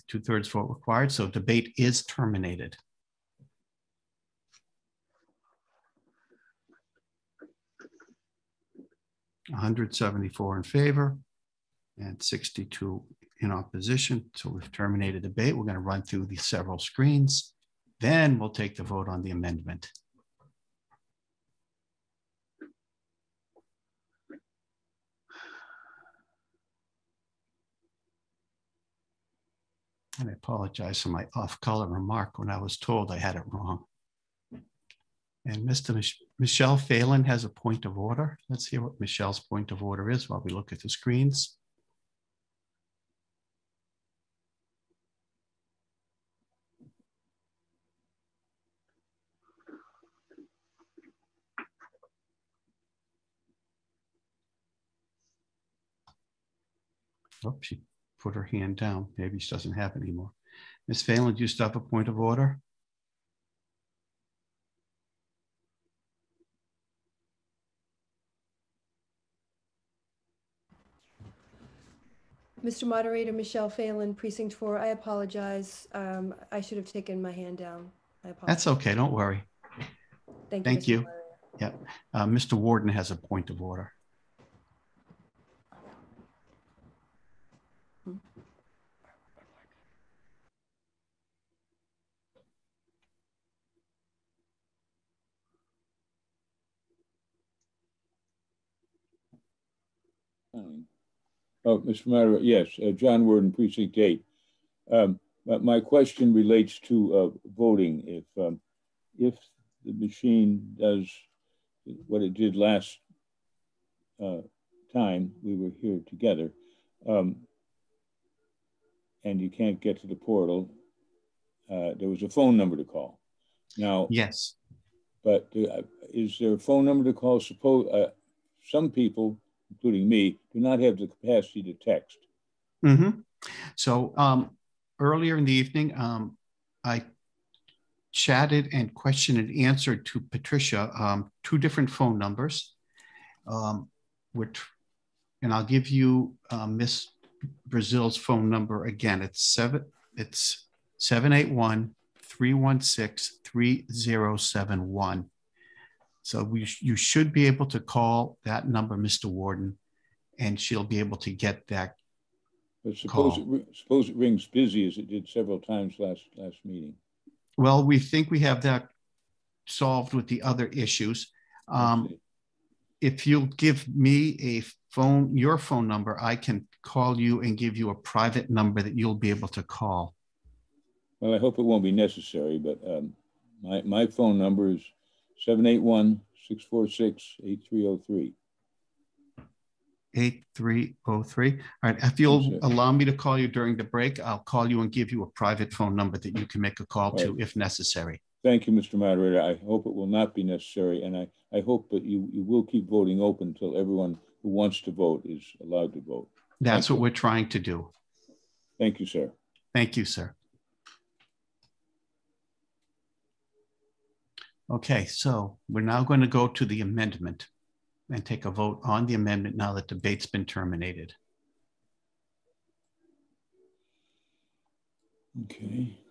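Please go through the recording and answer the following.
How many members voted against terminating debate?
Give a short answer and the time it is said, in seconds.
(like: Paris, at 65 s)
62, at 12 s.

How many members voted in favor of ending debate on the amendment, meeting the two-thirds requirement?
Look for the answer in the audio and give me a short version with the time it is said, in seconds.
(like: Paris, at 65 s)
174, at 9 s.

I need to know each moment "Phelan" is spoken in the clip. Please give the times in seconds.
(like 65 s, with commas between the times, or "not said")
36 s, 61 s, 73 s.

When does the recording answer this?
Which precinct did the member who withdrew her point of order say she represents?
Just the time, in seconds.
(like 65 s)
74 s.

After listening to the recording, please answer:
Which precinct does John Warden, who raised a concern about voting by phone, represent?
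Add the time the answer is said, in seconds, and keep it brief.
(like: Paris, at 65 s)
Precinct 8, at 103 s.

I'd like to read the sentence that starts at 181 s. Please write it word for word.
Well, I hope it won't be necessary, but um, my, my phone number is 781 646 8303.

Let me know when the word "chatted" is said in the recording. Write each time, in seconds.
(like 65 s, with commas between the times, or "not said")
138 s.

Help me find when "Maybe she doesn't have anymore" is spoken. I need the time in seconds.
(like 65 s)
59 s.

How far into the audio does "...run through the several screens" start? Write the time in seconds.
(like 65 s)
15 s.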